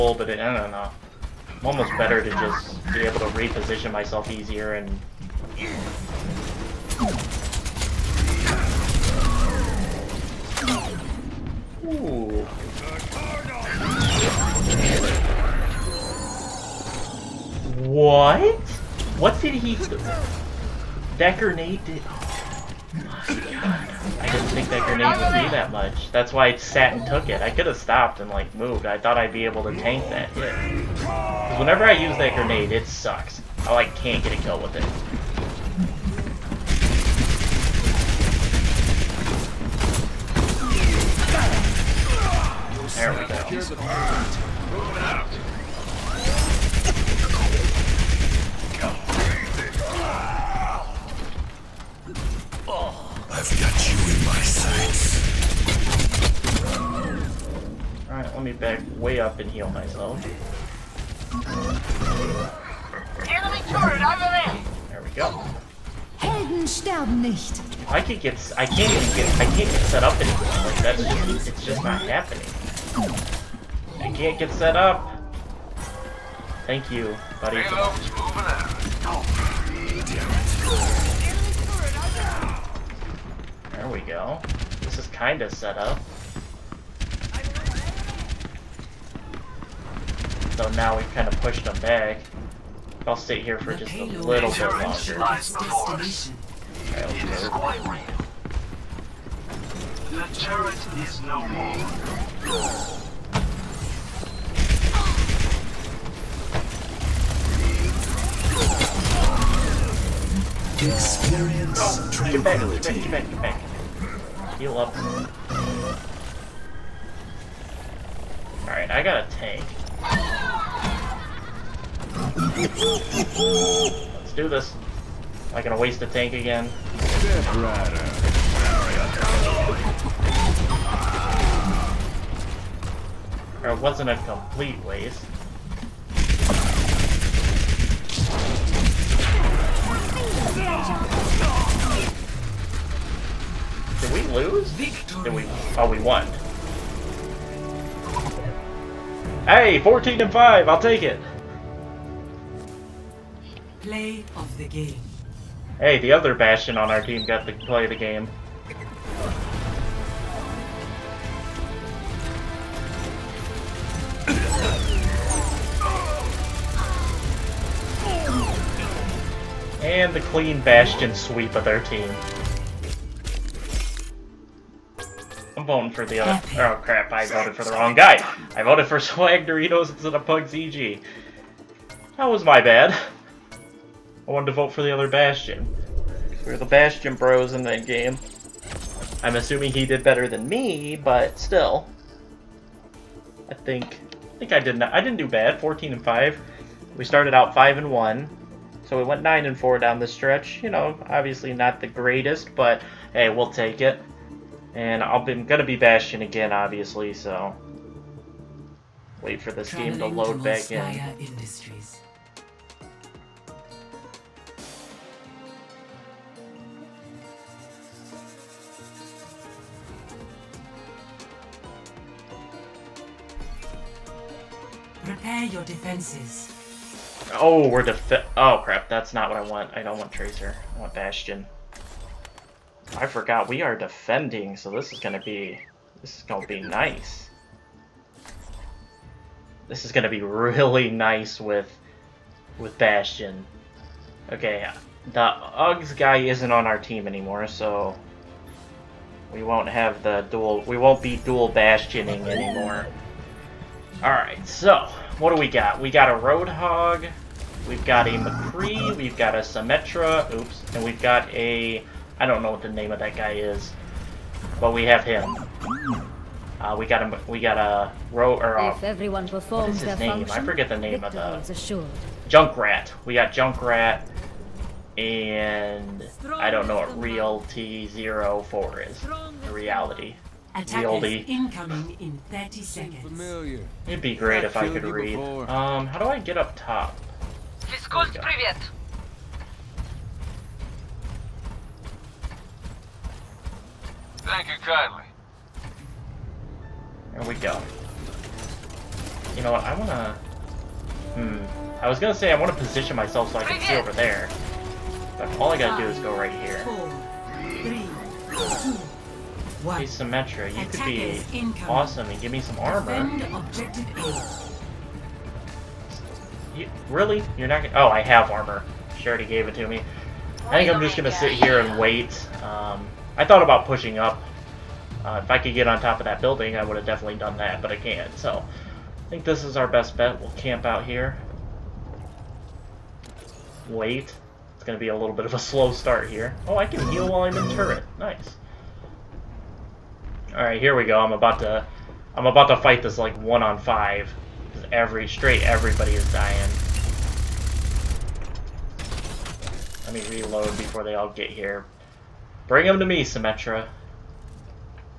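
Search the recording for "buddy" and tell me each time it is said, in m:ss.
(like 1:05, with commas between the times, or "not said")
1:17.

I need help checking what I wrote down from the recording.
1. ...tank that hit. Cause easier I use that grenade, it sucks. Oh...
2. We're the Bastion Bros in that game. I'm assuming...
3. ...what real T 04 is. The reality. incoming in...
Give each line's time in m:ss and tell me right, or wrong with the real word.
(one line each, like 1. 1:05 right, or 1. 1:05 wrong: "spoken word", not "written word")
1. 0:29 wrong: "whenever", not "easier"
2. 3:06 right
3. 4:36 right.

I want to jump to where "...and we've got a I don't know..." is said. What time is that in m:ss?
4:20.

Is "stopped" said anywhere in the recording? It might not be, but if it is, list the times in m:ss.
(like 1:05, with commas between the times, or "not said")
0:27.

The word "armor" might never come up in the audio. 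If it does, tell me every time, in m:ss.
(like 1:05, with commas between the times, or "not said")
5:12, 5:18.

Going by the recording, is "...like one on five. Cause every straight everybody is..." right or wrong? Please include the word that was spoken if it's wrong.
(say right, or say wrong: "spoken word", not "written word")
right.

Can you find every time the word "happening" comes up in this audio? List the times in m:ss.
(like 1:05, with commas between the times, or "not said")
1:12.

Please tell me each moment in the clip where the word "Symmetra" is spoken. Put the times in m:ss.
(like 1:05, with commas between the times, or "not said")
4:19, 5:09, 5:53.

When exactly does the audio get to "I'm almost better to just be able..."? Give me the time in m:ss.
0:01.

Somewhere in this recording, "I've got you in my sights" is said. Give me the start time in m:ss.
0:53.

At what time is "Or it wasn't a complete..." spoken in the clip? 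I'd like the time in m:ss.
2:13.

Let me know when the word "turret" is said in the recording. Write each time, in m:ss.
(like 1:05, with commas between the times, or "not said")
1:03, 1:40, 5:37.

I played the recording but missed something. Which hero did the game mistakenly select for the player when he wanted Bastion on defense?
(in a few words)
Tracer.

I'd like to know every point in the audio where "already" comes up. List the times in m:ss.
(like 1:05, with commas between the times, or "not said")
5:19.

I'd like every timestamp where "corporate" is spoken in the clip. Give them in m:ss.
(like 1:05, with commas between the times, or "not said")
not said.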